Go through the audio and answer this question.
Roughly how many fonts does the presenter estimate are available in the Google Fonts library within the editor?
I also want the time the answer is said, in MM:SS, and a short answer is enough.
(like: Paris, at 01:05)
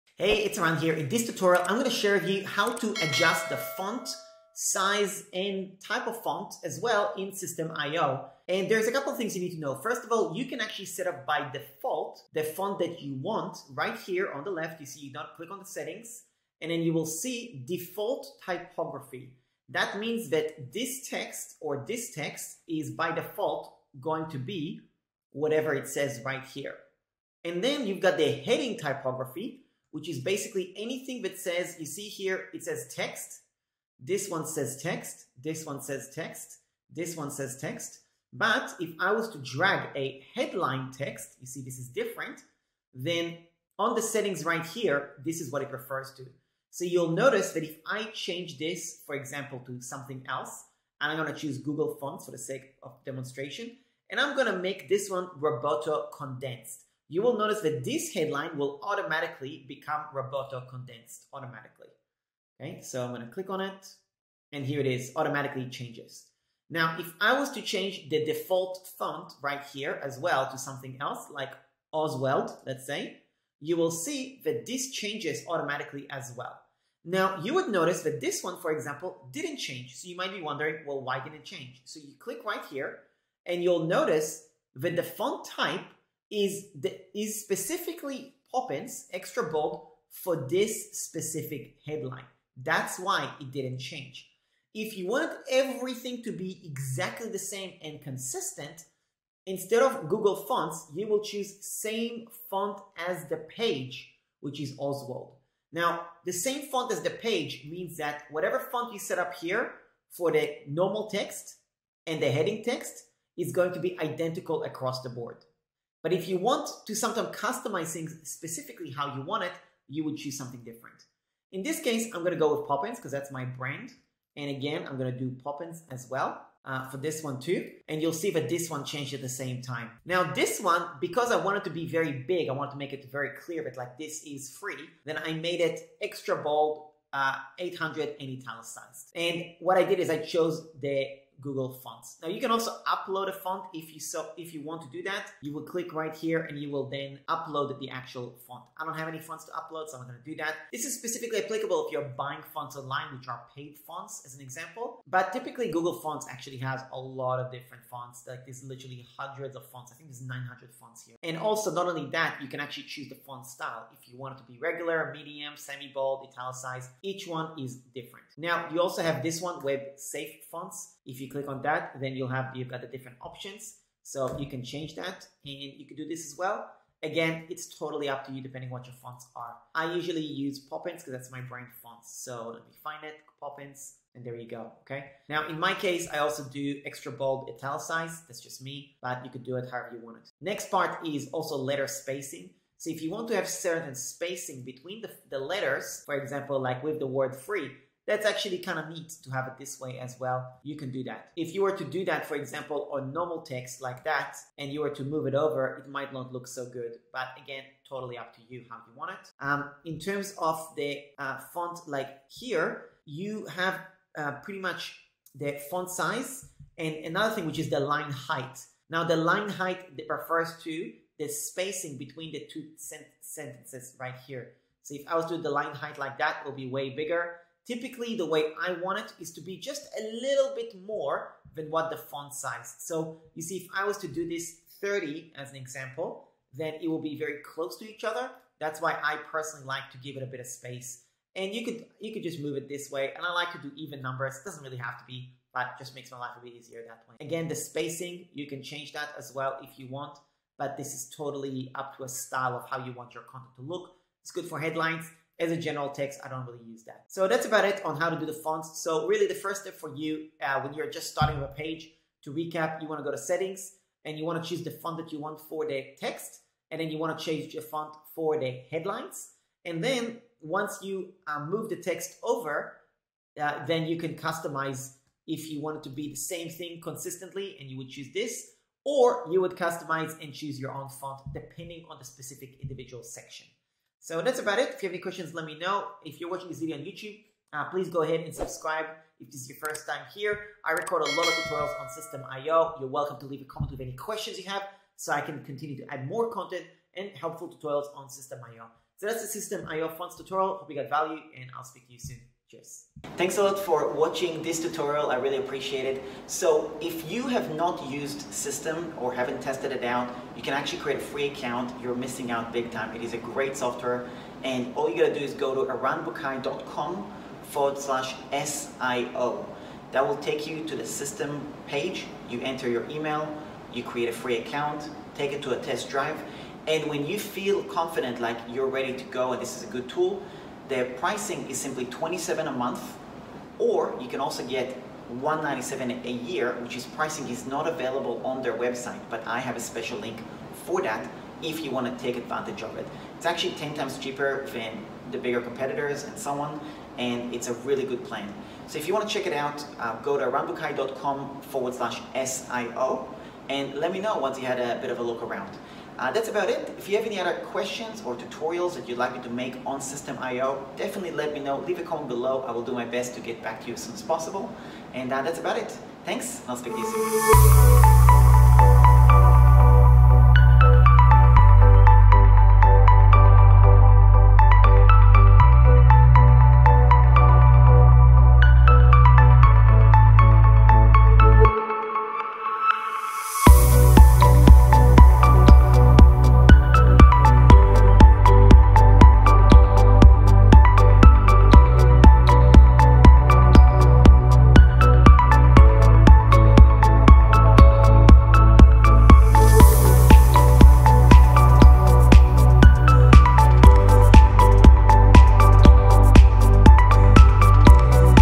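900, at 02:40.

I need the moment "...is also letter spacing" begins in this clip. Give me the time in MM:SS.
03:11.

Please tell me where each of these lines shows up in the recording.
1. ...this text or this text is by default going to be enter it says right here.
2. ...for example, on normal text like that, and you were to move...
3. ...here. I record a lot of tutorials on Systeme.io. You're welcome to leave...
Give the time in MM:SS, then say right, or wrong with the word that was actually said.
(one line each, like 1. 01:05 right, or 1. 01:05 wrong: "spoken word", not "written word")
1. 00:20 wrong: "whatever", not "enter"
2. 03:22 right
3. 04:50 right.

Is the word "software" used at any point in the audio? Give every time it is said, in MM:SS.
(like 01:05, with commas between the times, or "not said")
05:13.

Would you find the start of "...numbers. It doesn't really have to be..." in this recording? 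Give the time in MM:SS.
04:04.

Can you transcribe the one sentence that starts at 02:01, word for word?
In this case, I'm gonna go with Poppins because that's my brand.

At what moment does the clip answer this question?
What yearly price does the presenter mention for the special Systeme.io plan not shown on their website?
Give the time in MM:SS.
05:35.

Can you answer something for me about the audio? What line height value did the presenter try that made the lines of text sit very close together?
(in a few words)
30.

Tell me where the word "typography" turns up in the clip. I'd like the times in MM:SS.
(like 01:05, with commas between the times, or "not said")
00:18, 00:28.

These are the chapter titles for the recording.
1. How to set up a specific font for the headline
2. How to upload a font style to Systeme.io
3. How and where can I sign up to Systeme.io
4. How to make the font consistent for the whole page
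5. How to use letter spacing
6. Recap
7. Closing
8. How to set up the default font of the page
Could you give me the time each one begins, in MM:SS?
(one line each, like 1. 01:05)
1. 00:40
2. 02:25
3. 05:03
4. 01:35
5. 03:10
6. 04:22
7. 06:09
8. 00:13.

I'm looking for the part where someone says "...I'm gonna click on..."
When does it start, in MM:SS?
01:03.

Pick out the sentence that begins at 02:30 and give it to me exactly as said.
This is specifically applicable if you're buying fonts online, which are paid fonts as an example.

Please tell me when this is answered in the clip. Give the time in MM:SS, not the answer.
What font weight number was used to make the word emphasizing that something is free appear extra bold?
02:17.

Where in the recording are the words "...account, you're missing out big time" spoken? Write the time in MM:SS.
05:11.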